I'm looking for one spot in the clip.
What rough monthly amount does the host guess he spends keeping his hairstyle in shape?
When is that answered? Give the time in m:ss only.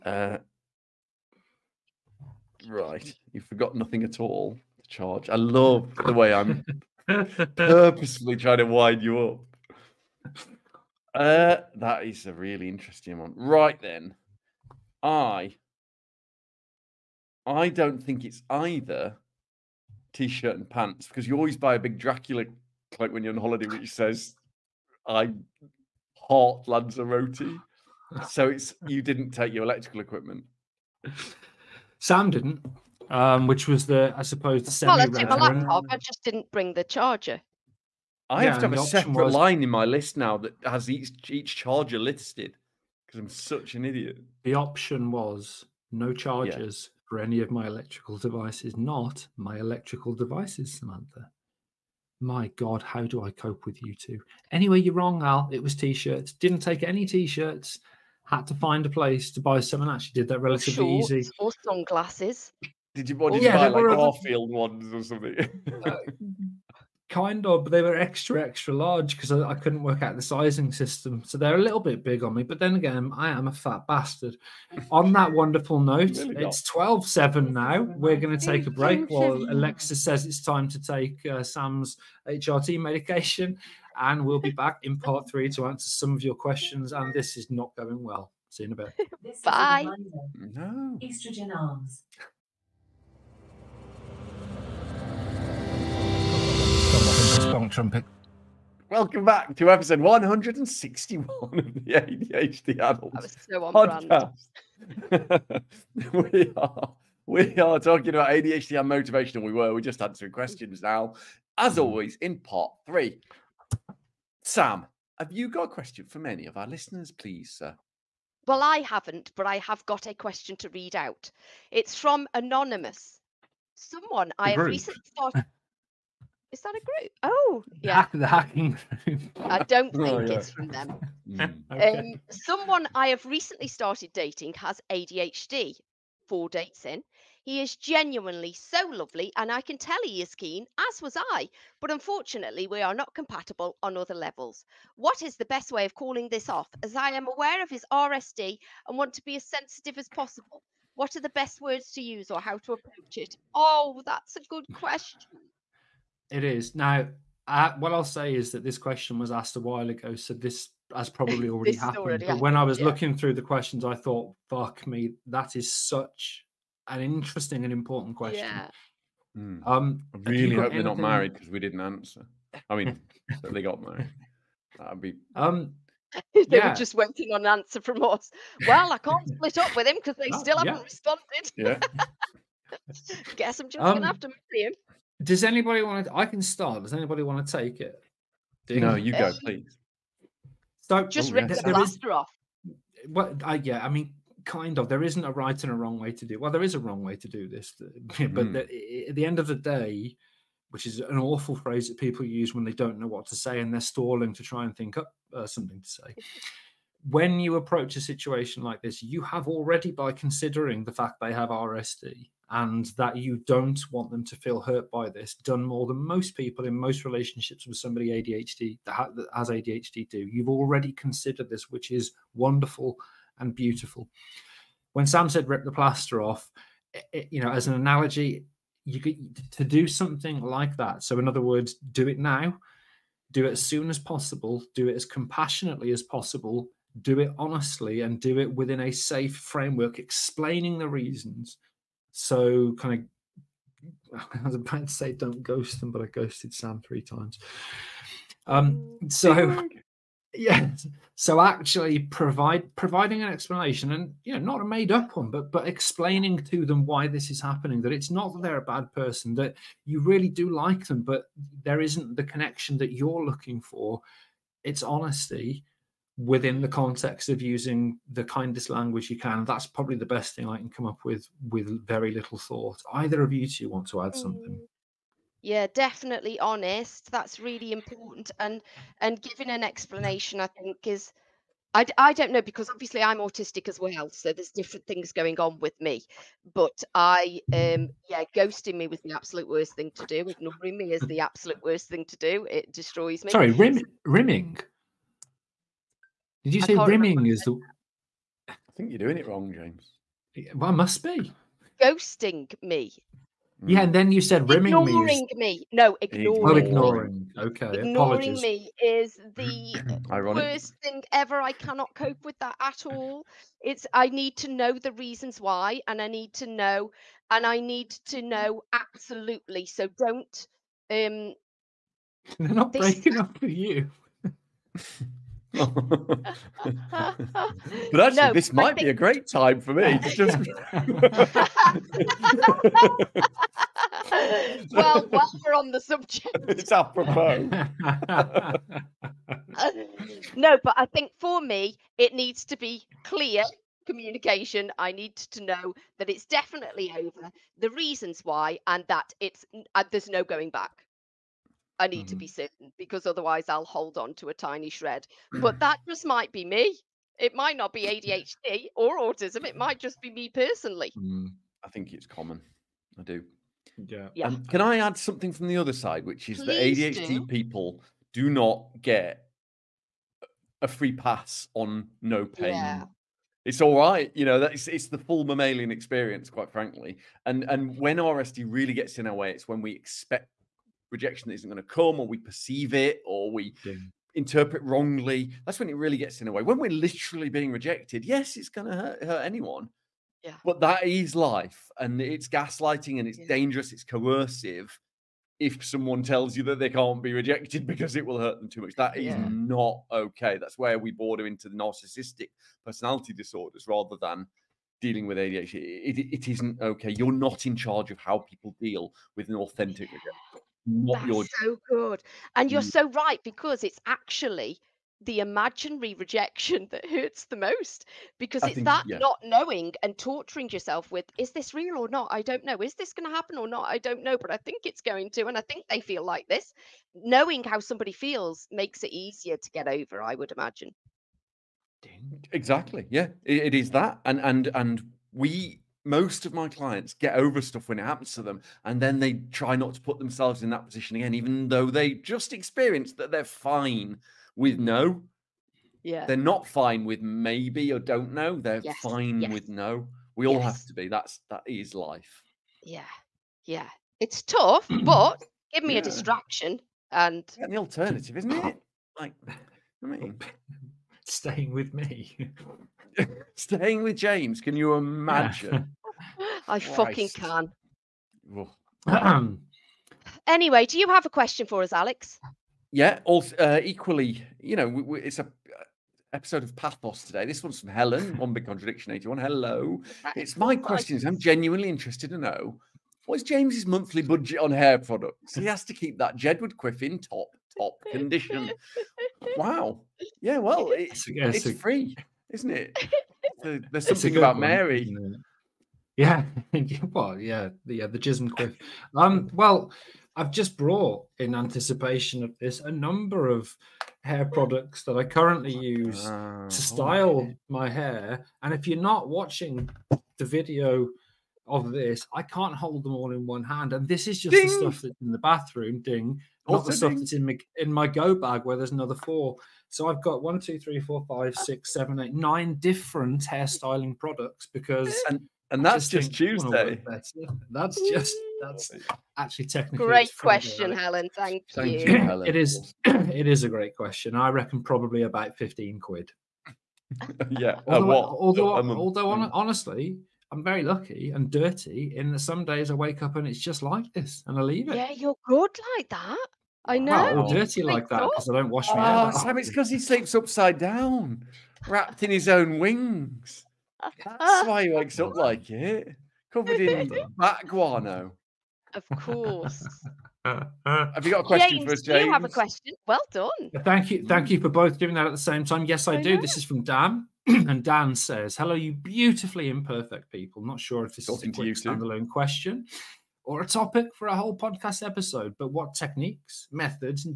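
8:55.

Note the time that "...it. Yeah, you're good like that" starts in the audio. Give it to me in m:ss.
9:04.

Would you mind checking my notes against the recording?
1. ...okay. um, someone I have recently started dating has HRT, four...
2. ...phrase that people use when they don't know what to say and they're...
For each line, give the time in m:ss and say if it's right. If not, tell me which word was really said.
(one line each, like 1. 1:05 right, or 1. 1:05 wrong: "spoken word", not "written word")
1. 2:11 wrong: "ADHD", not "HRT"
2. 3:21 right.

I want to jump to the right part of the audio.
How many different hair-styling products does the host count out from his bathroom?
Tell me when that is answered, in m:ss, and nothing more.
8:42.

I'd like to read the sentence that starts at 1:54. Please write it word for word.
Sam, have you got a question from any of our listeners, please, sir?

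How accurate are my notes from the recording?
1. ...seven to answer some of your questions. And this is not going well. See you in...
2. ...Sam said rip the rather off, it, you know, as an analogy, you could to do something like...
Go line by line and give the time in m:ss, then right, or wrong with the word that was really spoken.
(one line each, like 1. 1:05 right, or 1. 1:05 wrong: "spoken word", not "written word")
1. 1:25 wrong: "three", not "seven"
2. 3:45 wrong: "plaster", not "rather".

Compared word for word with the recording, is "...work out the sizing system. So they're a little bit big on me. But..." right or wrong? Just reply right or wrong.
right.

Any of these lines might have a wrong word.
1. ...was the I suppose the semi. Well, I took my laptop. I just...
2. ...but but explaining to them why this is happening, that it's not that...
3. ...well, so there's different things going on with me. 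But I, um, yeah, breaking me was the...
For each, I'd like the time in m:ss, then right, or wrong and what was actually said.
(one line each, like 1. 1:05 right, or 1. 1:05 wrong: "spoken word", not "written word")
1. 0:33 right
2. 4:15 right
3. 4:43 wrong: "ghosting", not "breaking".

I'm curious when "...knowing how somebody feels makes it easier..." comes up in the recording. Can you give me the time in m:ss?
7:06.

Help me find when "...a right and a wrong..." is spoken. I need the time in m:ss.
3:15.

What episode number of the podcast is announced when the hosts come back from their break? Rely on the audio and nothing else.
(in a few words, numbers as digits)
161.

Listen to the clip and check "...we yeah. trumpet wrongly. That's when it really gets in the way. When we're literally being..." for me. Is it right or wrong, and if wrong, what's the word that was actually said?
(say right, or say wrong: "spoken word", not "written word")
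wrong: "interpret", not "trumpet".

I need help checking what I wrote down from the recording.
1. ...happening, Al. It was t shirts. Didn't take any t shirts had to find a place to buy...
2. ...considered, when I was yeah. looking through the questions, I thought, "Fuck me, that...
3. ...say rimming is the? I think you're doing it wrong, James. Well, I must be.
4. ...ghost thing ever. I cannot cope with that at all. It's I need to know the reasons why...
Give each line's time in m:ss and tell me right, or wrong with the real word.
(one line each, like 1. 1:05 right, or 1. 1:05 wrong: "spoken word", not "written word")
1. 0:54 wrong: "wrong", not "happening"
2. 2:42 wrong: "happened", not "considered"
3. 4:56 right
4. 5:10 wrong: "worst", not "ghost".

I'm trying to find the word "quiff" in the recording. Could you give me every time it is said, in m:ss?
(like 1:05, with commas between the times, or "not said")
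8:06, 8:18.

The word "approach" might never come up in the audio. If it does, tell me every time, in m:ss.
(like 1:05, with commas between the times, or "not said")
2:32, 3:27.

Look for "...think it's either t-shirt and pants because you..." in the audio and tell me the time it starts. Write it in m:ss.
0:18.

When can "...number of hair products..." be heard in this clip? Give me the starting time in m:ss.
8:22.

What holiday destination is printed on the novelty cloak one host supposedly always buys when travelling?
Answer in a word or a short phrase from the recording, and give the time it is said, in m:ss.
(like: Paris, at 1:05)
Lanzarote, at 0:26.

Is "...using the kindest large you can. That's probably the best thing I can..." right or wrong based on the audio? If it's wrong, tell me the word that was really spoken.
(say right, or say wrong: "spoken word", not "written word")
wrong: "language", not "large".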